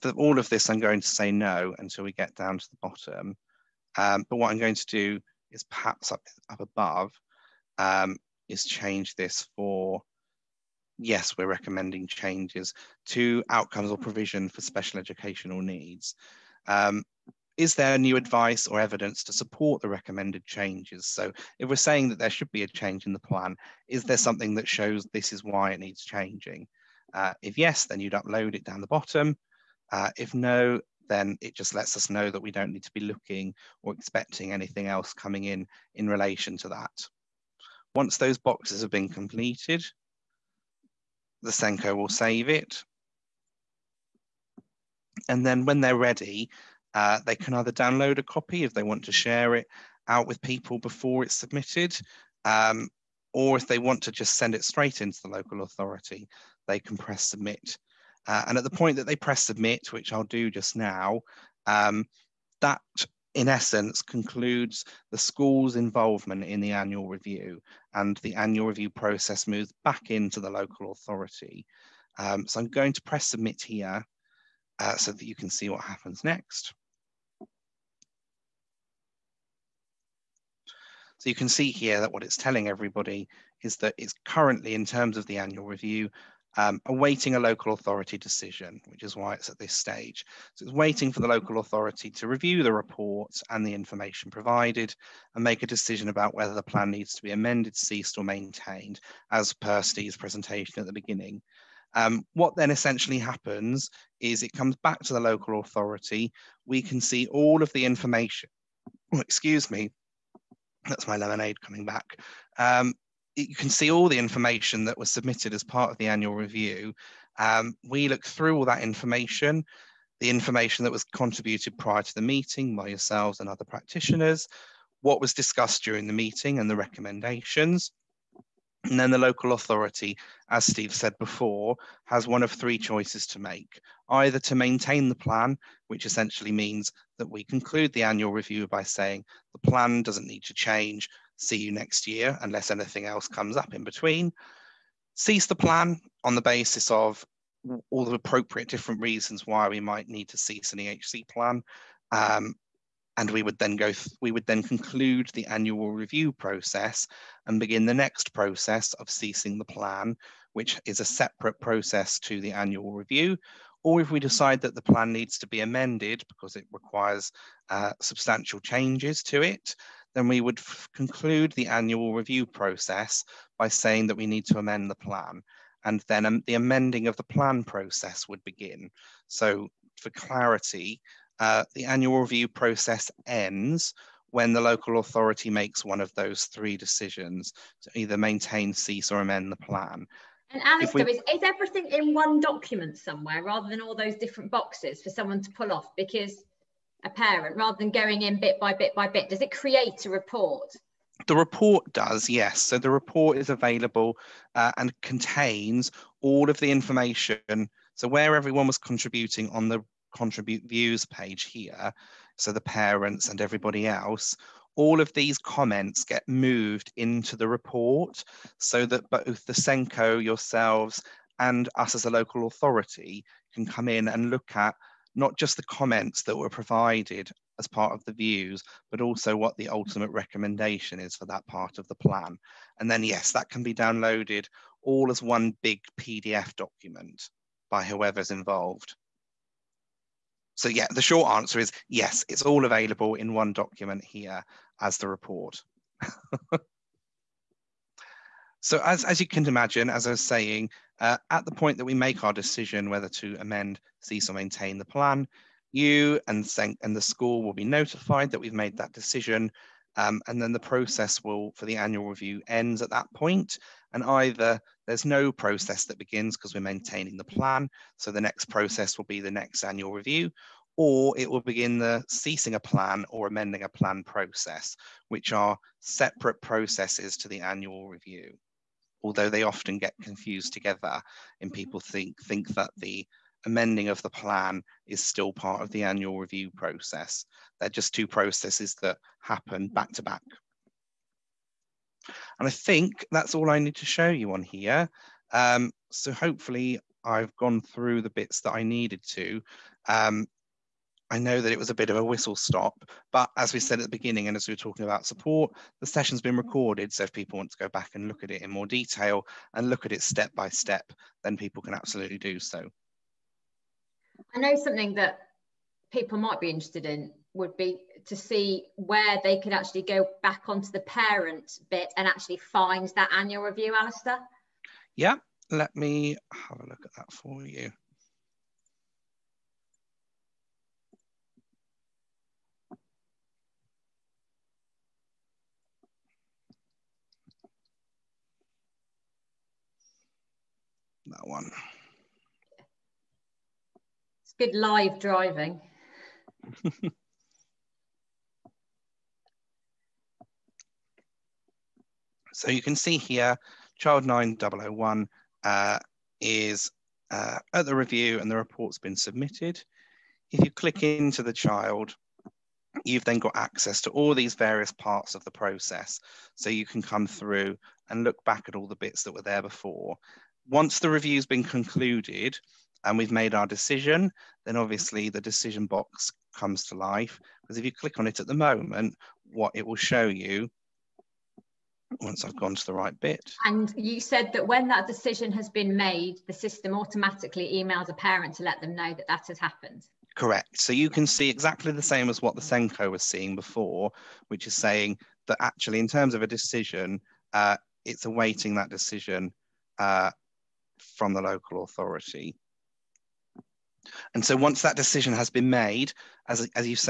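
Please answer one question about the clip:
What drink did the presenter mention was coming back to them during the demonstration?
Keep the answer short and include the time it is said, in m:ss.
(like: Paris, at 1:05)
Lemonade, at 1:51.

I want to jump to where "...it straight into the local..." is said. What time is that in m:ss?
0:54.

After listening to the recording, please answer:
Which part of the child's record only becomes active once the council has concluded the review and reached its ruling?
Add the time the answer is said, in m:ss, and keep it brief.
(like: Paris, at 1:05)
The decision box, at 6:15.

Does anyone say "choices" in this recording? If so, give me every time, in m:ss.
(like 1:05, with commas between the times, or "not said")
2:12.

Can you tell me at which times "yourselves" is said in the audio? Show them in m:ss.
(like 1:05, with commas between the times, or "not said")
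2:02, 3:40.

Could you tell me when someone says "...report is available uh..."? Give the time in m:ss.
3:22.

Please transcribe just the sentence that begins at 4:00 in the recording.
So yeah, the short answer is yes, it's all available in one document here as the report.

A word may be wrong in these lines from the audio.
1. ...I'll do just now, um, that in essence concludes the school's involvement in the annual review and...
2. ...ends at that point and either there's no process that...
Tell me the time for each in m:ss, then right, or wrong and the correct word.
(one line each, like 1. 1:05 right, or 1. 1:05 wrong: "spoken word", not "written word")
1. 1:00 right
2. 4:22 right.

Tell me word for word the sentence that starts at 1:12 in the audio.
Um, so I'm going to press submit here uh, so that you can see what happens next.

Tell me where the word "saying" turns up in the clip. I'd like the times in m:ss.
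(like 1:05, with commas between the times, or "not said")
0:21, 2:18, 2:53, 4:10, 6:34.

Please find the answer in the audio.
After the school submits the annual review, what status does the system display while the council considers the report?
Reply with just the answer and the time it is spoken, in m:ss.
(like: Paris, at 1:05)
Awaiting a local authority decision, at 1:26.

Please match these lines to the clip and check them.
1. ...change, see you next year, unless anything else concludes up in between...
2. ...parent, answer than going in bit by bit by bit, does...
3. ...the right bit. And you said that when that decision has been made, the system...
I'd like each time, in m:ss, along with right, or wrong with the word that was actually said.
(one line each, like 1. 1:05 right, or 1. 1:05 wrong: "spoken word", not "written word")
1. 2:20 wrong: "comes", not "concludes"
2. 3:17 wrong: "rather", not "answer"
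3. 6:22 right.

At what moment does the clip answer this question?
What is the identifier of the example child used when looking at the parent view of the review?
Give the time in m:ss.
5:53.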